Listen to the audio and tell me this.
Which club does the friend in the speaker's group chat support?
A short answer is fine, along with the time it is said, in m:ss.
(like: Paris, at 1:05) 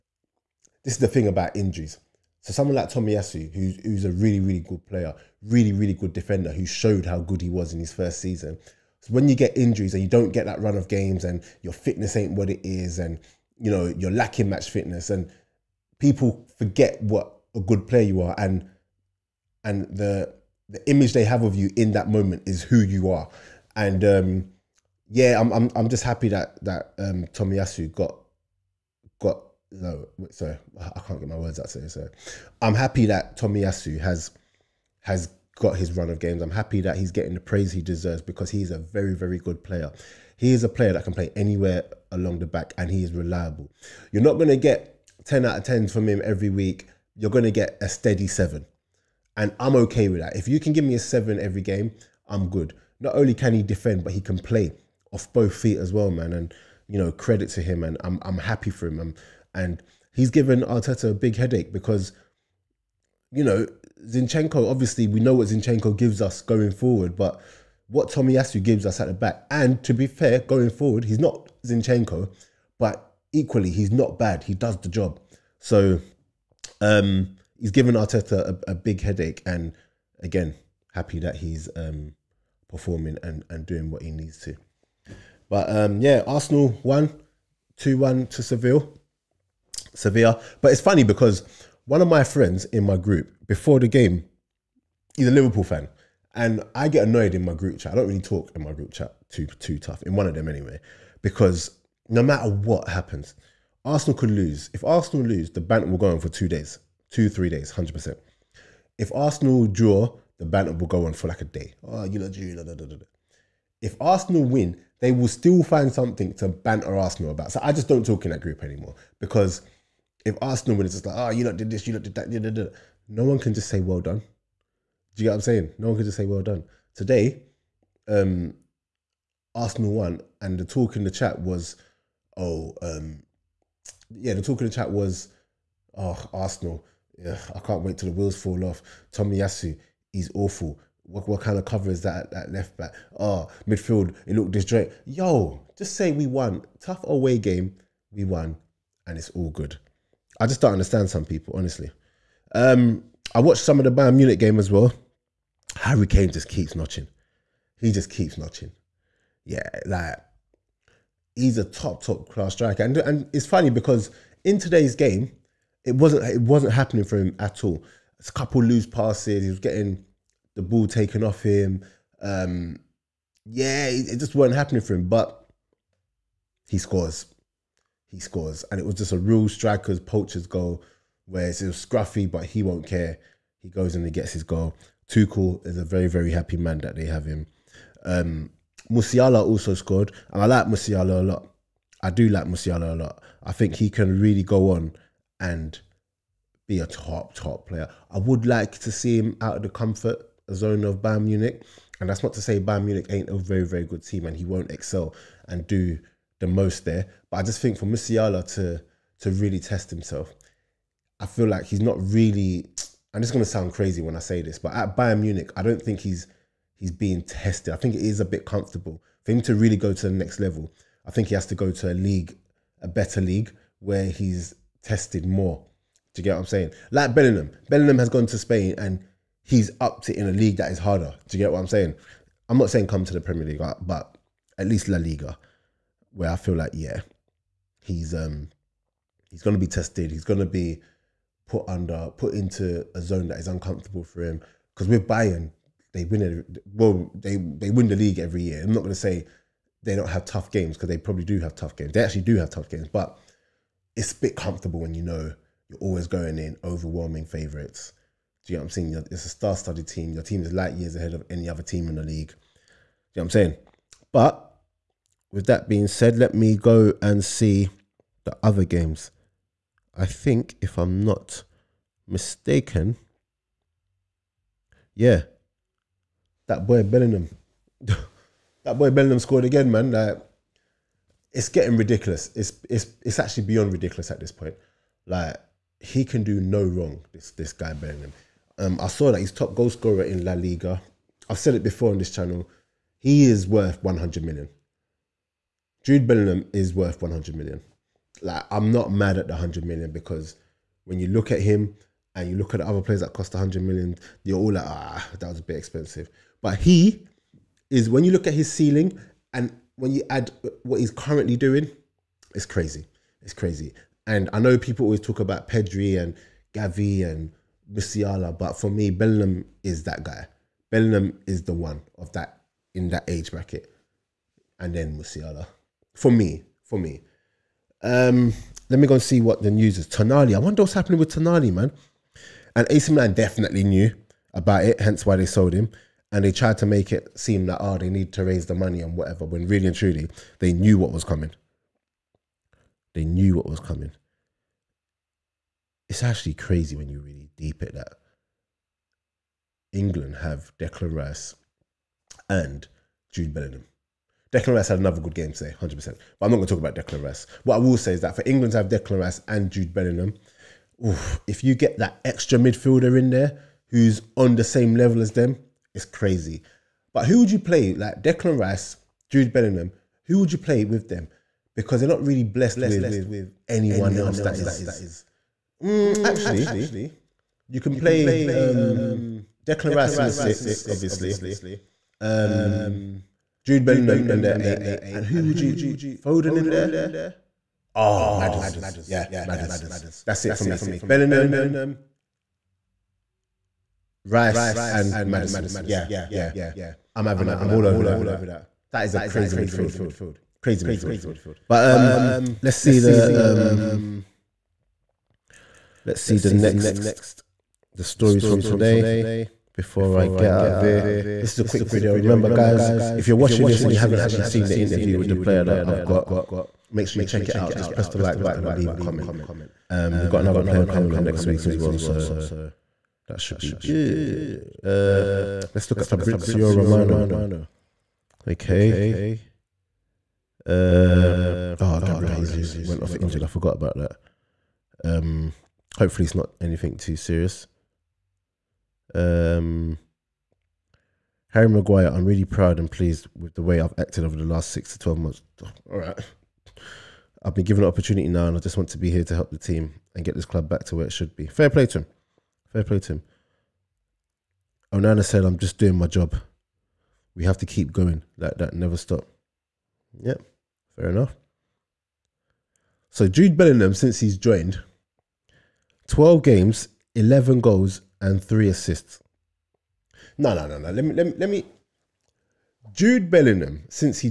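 Liverpool, at 1:35.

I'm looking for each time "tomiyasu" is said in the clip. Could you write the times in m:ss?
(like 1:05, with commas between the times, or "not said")
0:02, 0:27, 0:33, 1:08, 2:19.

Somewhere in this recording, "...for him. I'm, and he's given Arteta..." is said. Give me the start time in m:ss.
0:58.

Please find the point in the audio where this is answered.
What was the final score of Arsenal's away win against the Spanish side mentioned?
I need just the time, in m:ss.
1:27.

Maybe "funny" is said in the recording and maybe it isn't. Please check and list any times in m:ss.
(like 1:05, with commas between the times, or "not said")
1:30, 2:43.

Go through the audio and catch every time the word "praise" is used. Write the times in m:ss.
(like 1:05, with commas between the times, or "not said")
0:37.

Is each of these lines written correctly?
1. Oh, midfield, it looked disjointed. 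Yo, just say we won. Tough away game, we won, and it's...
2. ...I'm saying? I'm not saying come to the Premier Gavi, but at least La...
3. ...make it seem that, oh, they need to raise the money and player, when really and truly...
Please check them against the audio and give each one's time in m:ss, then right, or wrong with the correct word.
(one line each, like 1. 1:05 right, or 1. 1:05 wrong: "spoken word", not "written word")
1. 2:23 right
2. 3:51 wrong: "League", not "Gavi"
3. 5:36 wrong: "whatever", not "player".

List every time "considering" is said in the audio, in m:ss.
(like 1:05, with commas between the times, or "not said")
not said.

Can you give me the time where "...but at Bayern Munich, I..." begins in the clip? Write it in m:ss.
3:34.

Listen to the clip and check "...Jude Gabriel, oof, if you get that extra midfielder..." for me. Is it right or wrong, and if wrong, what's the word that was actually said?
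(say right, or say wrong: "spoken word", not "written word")
wrong: "Bellingham", not "Gabriel".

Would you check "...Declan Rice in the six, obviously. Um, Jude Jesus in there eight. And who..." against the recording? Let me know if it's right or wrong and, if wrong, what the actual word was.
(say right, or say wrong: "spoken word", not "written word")
wrong: "Bellingham", not "Jesus".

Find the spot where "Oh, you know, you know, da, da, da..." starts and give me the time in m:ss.
1:51.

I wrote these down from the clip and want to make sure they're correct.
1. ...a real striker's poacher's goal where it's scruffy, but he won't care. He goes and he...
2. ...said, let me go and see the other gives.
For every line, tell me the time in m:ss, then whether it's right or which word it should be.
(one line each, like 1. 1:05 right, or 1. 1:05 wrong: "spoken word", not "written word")
1. 2:59 right
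2. 4:25 wrong: "games", not "gives".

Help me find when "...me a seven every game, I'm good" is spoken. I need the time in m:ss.
0:50.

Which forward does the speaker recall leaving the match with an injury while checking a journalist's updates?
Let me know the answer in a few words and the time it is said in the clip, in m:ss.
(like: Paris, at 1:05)
Gabriel Jesus, at 7:11.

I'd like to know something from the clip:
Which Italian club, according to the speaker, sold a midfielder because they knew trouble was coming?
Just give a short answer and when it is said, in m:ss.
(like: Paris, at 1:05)
AC Milan, at 5:32.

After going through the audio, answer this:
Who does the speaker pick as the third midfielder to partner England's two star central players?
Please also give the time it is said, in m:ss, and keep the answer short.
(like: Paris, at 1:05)
Maddison, at 6:35.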